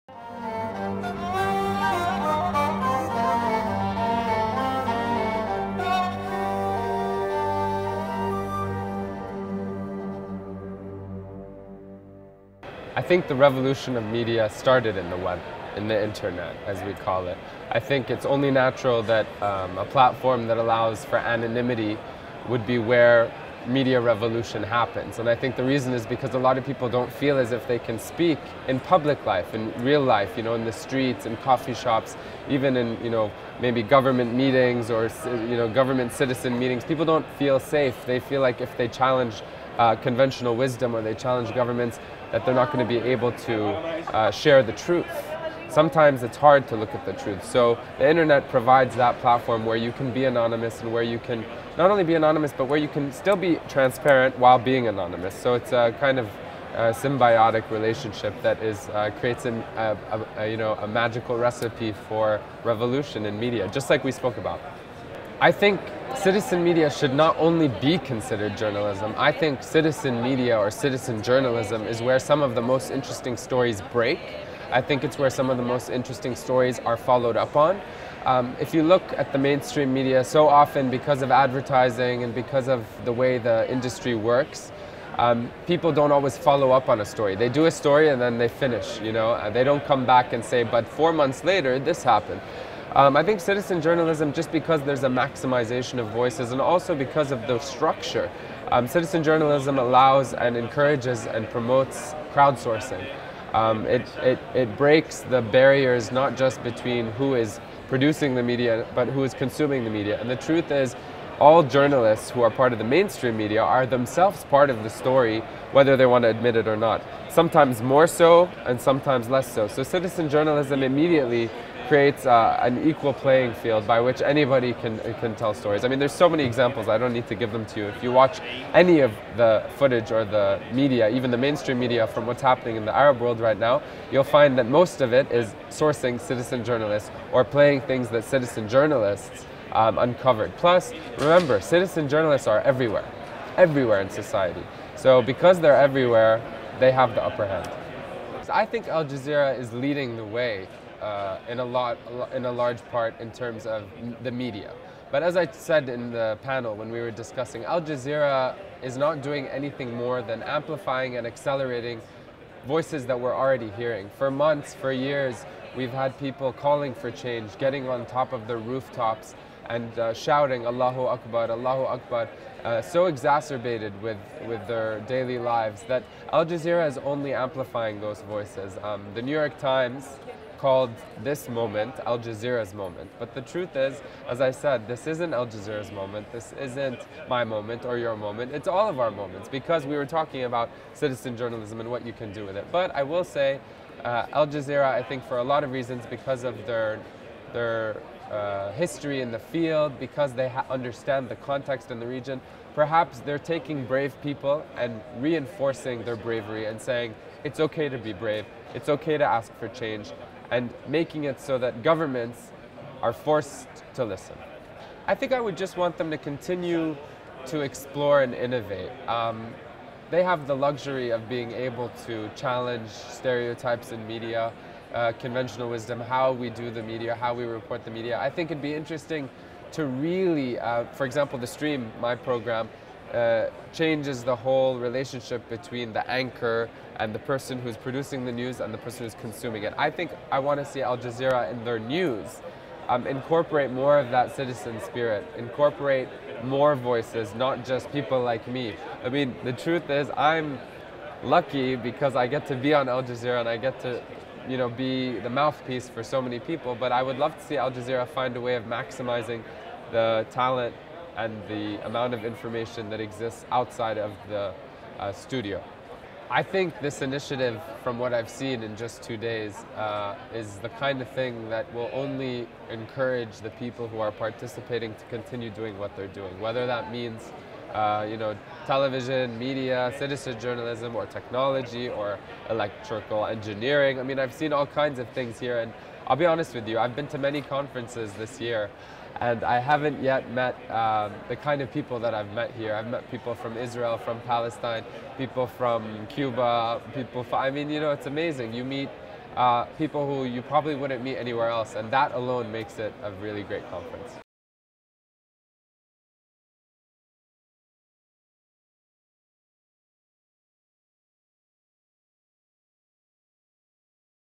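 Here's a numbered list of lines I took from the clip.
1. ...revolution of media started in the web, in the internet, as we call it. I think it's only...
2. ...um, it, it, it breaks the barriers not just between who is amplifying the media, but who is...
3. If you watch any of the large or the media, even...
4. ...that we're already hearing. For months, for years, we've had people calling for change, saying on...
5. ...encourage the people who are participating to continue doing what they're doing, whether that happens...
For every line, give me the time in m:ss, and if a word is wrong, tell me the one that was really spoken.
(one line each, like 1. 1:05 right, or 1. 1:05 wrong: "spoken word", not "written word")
1. 0:13 right
2. 1:43 wrong: "producing", not "amplifying"
3. 2:07 wrong: "footage", not "large"
4. 2:43 wrong: "getting", not "saying"
5. 4:32 wrong: "means", not "happens".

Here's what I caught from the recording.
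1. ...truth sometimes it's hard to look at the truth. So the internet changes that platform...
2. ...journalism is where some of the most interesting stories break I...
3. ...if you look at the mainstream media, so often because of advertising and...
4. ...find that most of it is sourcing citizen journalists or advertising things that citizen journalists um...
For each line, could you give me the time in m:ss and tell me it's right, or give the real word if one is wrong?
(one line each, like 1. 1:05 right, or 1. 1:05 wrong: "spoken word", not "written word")
1. 0:44 wrong: "provides", not "changes"
2. 1:11 right
3. 1:18 right
4. 2:14 wrong: "playing", not "advertising".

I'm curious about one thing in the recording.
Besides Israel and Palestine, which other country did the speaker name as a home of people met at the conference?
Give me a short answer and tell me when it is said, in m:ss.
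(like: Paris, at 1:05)
Cuba, at 4:56.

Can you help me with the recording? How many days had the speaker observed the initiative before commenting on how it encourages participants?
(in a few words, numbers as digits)
2.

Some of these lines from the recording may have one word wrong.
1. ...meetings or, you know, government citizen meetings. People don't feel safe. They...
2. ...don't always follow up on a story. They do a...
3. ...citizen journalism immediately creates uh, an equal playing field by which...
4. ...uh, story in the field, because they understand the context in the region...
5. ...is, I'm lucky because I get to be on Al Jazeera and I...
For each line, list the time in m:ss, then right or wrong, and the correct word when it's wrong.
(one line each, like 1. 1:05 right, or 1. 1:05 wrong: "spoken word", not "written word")
1. 0:34 right
2. 1:25 right
3. 1:59 right
4. 3:18 wrong: "history", not "story"
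5. 4:09 right.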